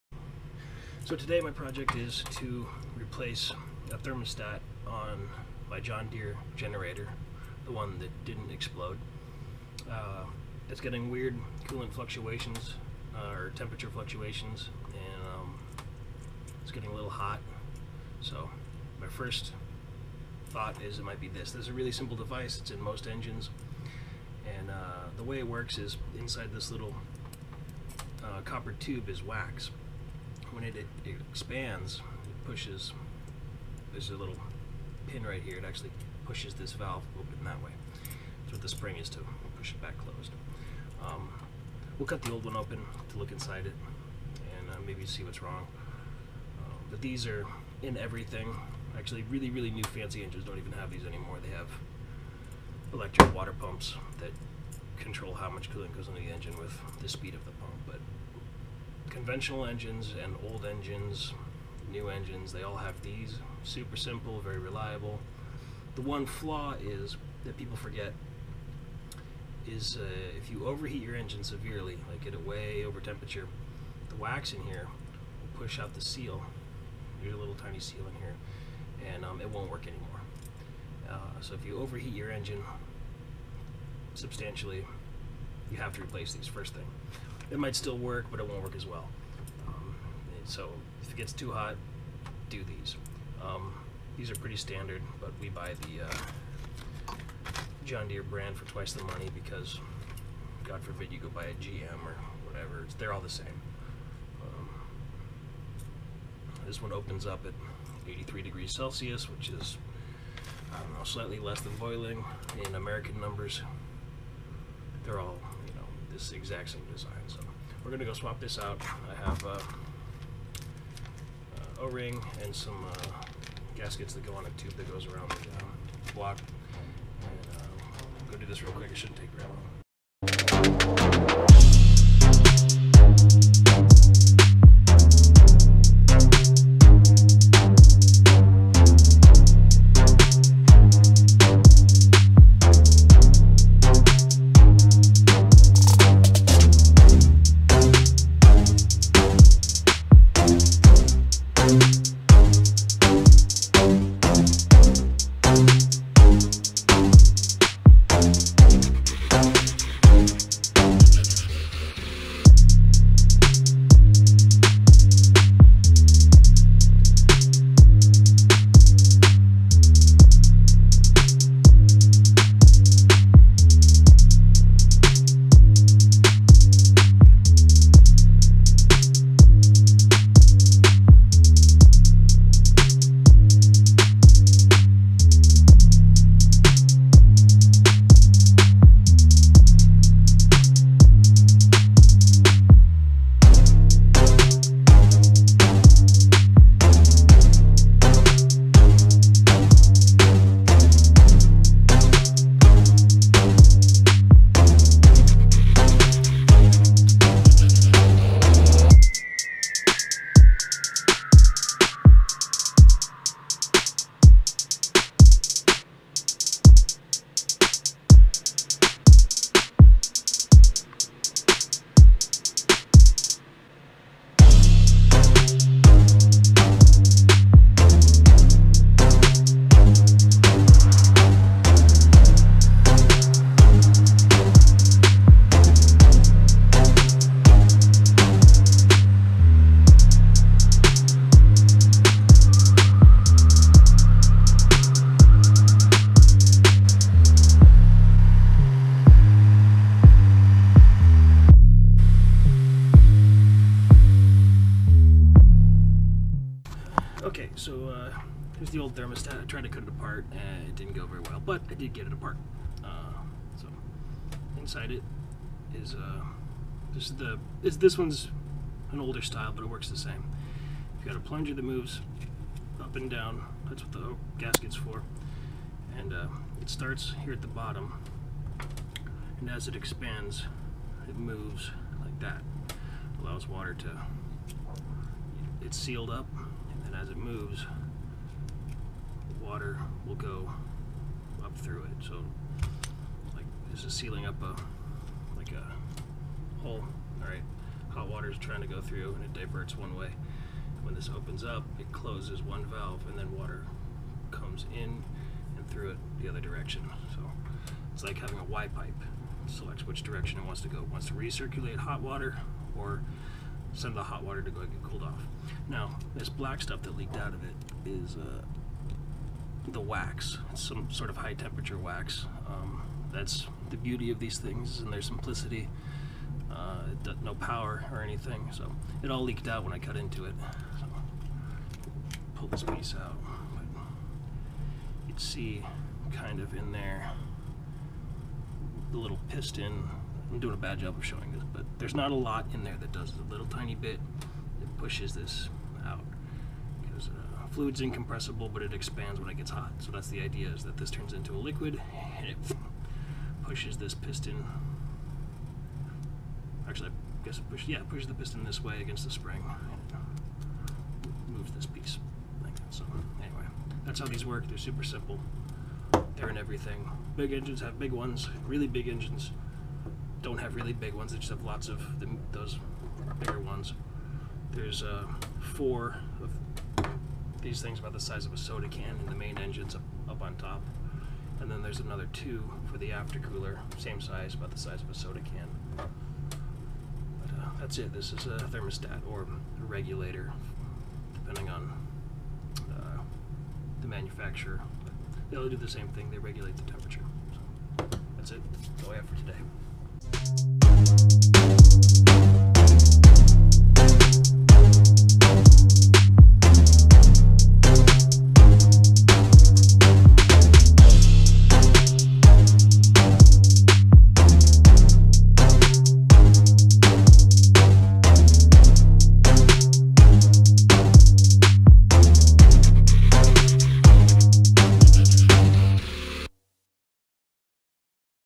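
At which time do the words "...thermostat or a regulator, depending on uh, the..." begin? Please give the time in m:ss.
6:28.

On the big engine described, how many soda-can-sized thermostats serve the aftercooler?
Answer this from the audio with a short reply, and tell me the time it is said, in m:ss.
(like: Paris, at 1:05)
2, at 6:22.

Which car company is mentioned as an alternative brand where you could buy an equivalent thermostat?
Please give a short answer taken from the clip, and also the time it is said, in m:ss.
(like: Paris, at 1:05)
GM, at 1:41.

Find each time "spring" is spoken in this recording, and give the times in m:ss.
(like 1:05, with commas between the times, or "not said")
0:38, 5:59.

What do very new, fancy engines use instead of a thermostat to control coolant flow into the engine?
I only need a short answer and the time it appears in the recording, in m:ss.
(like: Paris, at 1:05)
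Electric water pumps, at 0:52.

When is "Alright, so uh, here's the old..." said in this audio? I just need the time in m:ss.
4:17.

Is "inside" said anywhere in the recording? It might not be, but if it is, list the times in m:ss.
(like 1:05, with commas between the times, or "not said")
0:26, 0:43, 4:24.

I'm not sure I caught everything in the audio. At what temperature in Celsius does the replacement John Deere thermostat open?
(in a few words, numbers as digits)
83 degrees.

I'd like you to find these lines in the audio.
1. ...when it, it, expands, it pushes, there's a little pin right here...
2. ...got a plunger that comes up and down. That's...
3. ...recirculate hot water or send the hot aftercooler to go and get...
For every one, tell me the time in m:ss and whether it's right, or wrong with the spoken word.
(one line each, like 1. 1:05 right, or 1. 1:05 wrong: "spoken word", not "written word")
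1. 0:30 right
2. 4:31 wrong: "moves", not "comes"
3. 5:11 wrong: "water", not "aftercooler".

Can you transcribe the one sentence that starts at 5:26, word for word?
Uh, no power or anything, so it all leaked out when I cut into it.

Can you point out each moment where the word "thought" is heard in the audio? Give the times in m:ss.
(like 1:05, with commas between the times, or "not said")
0:20.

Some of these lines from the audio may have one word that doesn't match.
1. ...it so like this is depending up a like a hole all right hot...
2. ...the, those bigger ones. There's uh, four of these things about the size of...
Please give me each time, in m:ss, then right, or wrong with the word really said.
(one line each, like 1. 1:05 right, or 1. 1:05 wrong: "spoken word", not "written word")
1. 4:51 wrong: "sealing", not "depending"
2. 6:11 right.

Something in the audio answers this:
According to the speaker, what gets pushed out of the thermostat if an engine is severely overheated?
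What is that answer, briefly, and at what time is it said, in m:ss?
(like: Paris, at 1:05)
The seal, at 1:15.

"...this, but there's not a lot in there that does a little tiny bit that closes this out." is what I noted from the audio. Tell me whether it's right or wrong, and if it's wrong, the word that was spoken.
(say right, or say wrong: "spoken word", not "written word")
wrong: "pushes", not "closes".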